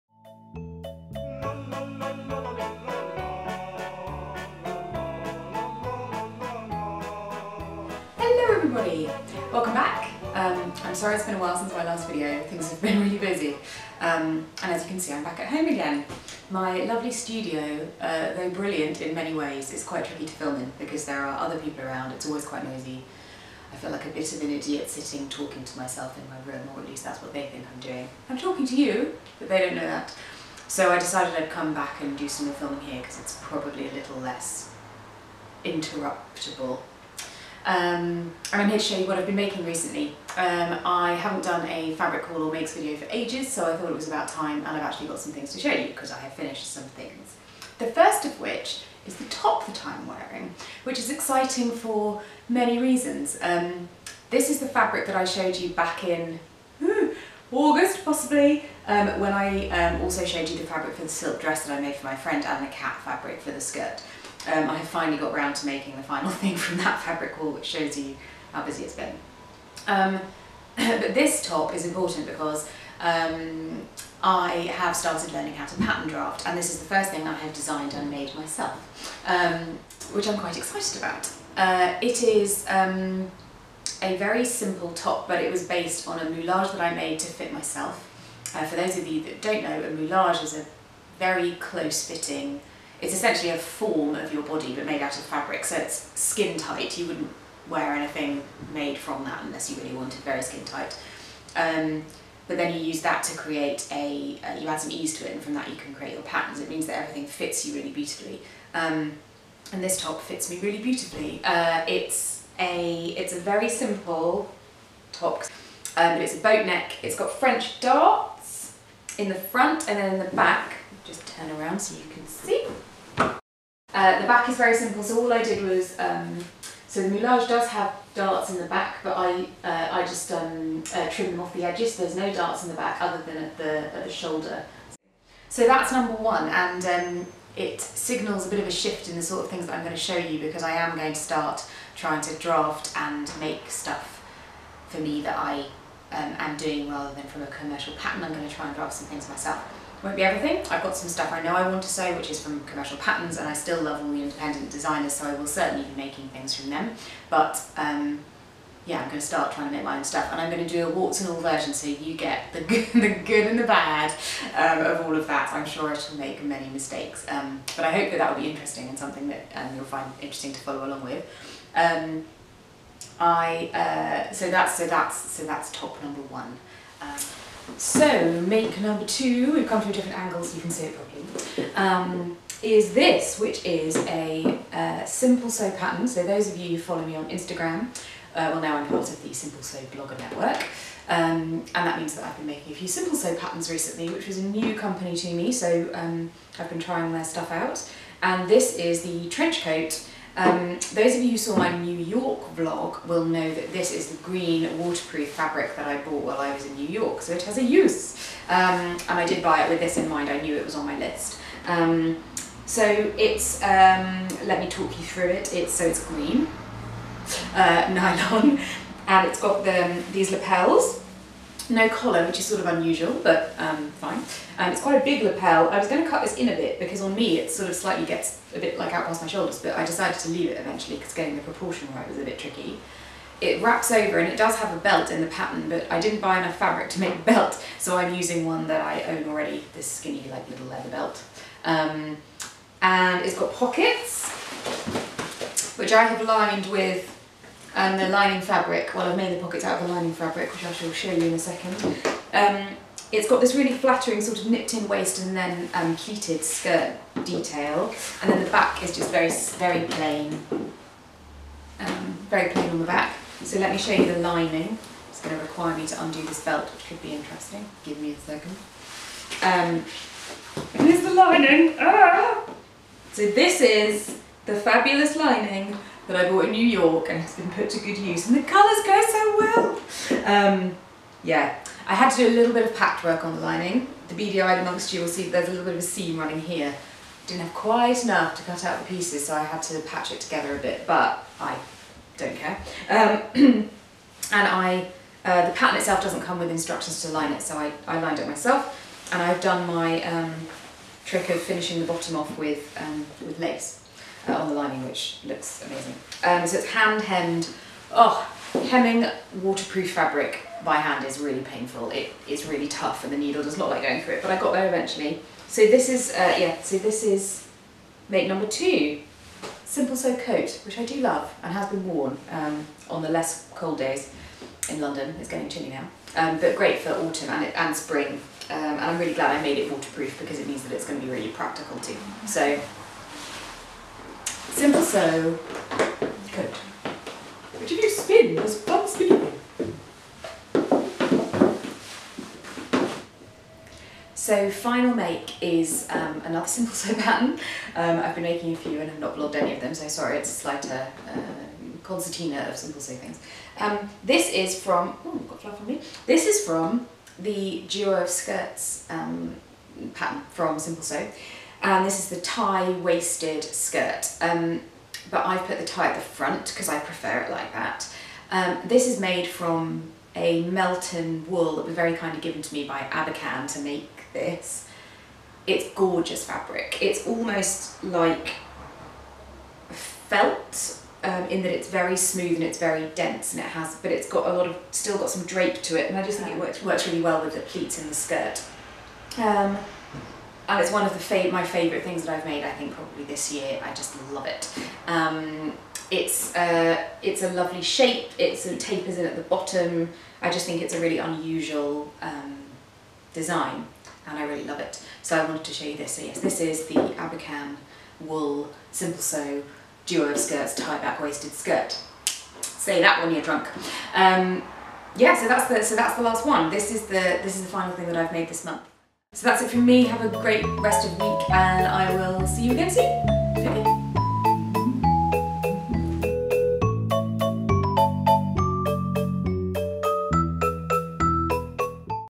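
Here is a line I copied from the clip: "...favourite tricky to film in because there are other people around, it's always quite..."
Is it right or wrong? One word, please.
wrong.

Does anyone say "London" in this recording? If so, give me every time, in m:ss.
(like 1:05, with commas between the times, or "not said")
5:24.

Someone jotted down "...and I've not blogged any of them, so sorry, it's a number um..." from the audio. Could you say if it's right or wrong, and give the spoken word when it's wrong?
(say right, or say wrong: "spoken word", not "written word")
wrong: "slighter", not "number".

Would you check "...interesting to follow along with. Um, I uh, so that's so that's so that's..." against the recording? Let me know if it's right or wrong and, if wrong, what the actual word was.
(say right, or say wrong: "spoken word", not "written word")
right.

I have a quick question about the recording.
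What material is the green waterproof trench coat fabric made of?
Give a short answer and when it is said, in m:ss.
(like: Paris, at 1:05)
nylon, at 3:37.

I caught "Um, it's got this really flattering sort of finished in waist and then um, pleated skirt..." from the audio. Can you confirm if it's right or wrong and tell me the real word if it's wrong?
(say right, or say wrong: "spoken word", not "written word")
wrong: "nipped", not "finished".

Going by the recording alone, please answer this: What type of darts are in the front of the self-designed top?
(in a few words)
French darts.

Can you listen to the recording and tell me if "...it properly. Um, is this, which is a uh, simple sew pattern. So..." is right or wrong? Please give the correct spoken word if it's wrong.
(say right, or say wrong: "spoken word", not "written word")
right.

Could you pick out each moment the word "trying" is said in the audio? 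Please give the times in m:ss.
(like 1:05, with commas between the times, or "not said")
2:21, 2:39, 3:16.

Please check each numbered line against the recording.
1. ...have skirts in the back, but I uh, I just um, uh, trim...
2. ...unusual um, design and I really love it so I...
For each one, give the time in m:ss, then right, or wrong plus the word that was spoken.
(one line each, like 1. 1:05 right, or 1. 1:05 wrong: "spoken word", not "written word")
1. 2:07 wrong: "darts", not "skirts"
2. 6:40 right.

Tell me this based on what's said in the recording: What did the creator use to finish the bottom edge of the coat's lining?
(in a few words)
lace.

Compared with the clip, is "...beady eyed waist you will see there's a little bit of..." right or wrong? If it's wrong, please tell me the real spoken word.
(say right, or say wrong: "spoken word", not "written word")
wrong: "amongst", not "waist".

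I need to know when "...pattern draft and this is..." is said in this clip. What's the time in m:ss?
1:15.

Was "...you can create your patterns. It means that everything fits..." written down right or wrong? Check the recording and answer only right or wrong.
right.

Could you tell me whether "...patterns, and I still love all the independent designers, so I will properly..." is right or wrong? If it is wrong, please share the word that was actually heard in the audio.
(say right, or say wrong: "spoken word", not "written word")
wrong: "certainly", not "properly".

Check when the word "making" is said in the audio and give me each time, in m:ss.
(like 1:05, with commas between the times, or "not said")
0:39, 1:05, 2:35, 3:12, 5:48.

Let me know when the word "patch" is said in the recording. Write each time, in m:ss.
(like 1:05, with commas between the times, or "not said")
4:42, 4:49.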